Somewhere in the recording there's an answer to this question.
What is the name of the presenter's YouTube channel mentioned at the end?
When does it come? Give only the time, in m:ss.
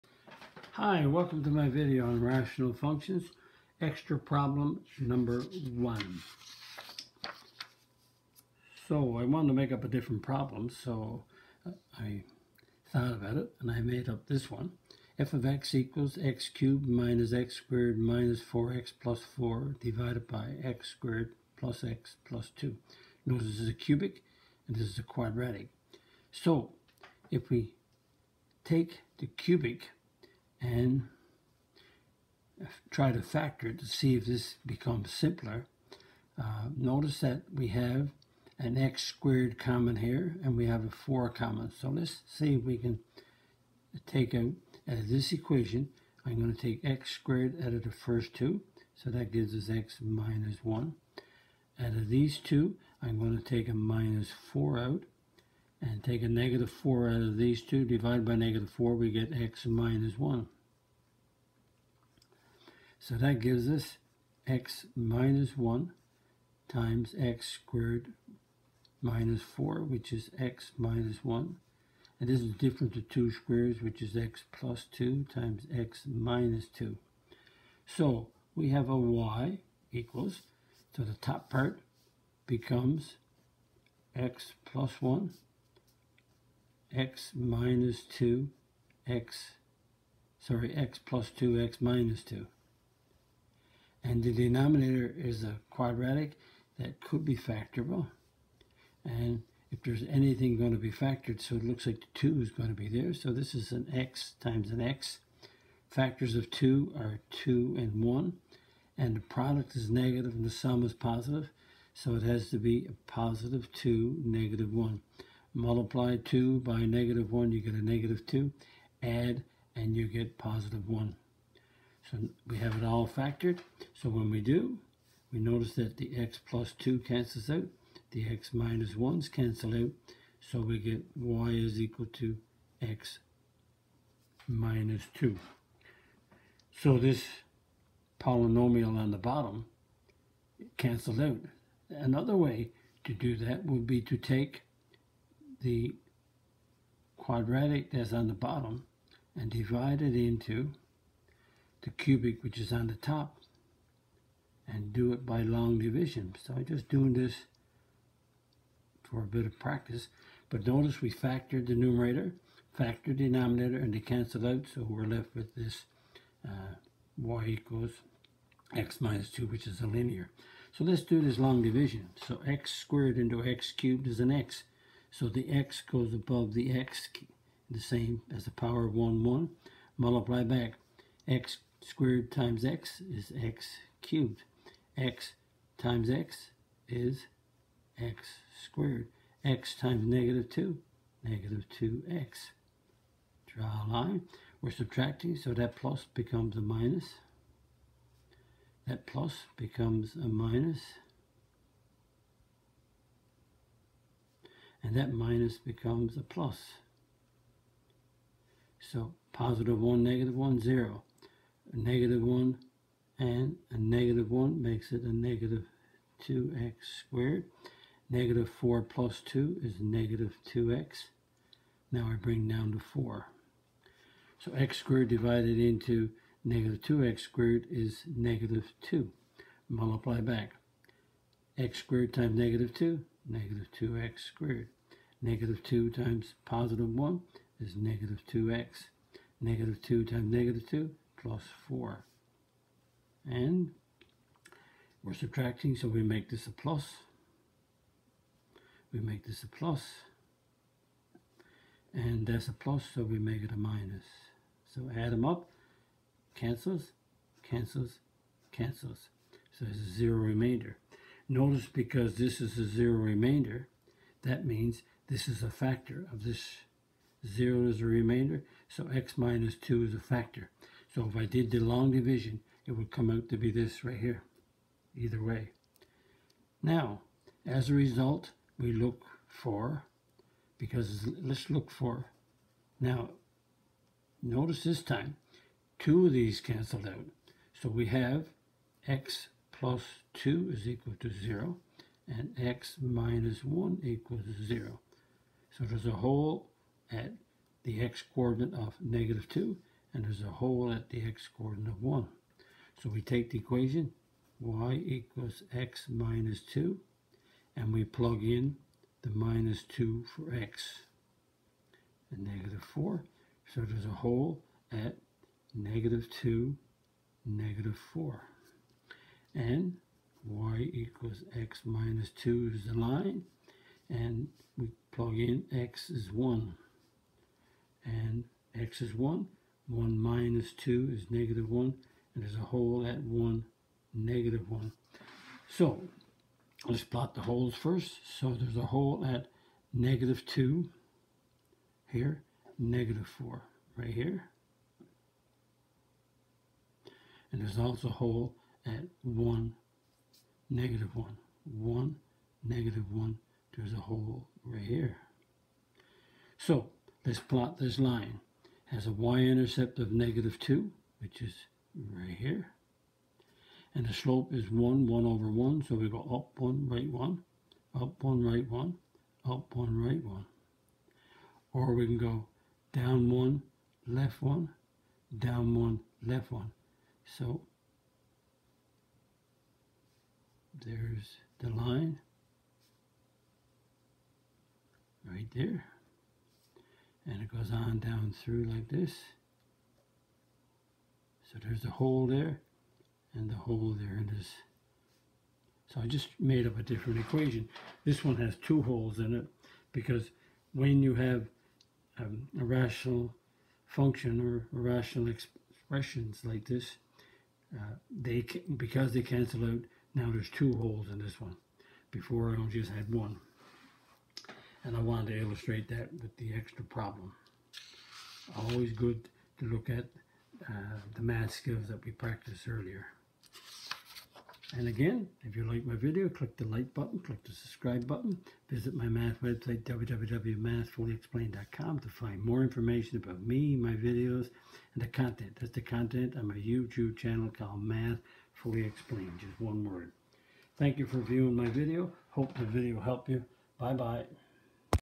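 7:17.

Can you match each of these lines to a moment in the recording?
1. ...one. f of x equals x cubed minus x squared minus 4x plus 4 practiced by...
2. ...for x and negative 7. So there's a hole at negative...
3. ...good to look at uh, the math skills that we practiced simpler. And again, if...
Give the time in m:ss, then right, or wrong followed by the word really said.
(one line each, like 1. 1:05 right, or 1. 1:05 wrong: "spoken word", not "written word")
1. 0:14 wrong: "divided", not "practiced"
2. 5:10 wrong: "4", not "7"
3. 6:58 wrong: "earlier", not "simpler".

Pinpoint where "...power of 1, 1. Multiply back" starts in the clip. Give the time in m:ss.
2:58.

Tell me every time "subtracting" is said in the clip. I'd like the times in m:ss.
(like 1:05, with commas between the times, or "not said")
3:14, 4:05.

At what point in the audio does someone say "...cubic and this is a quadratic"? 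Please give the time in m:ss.
0:23.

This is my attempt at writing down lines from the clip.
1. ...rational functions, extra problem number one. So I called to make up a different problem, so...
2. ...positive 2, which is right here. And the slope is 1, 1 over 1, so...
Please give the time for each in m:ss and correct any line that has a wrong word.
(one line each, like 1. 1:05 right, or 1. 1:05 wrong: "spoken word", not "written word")
1. 0:02 wrong: "wanted", not "called"
2. 5:59 wrong: "negative", not "positive".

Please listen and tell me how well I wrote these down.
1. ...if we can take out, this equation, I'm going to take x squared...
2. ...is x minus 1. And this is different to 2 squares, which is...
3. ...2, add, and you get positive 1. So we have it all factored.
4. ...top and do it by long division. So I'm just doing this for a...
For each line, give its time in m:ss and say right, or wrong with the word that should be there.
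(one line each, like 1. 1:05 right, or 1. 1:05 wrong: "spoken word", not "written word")
1. 0:42 right
2. 1:10 right
3. 1:58 right
4. 2:32 right.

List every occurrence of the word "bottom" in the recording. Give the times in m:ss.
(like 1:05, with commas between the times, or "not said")
2:19, 2:28.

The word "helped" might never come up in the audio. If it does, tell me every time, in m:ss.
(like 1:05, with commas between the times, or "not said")
7:22.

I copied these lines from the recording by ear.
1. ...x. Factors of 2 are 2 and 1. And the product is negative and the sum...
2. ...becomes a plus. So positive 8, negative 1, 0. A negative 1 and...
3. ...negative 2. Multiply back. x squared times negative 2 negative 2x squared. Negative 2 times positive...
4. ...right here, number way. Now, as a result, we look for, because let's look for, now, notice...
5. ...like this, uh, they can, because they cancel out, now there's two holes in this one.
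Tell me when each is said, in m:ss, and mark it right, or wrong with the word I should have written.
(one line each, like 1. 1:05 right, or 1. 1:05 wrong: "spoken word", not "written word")
1. 1:44 right
2. 3:25 wrong: "1", not "8"
3. 3:48 right
4. 4:33 wrong: "either", not "number"
5. 6:46 right.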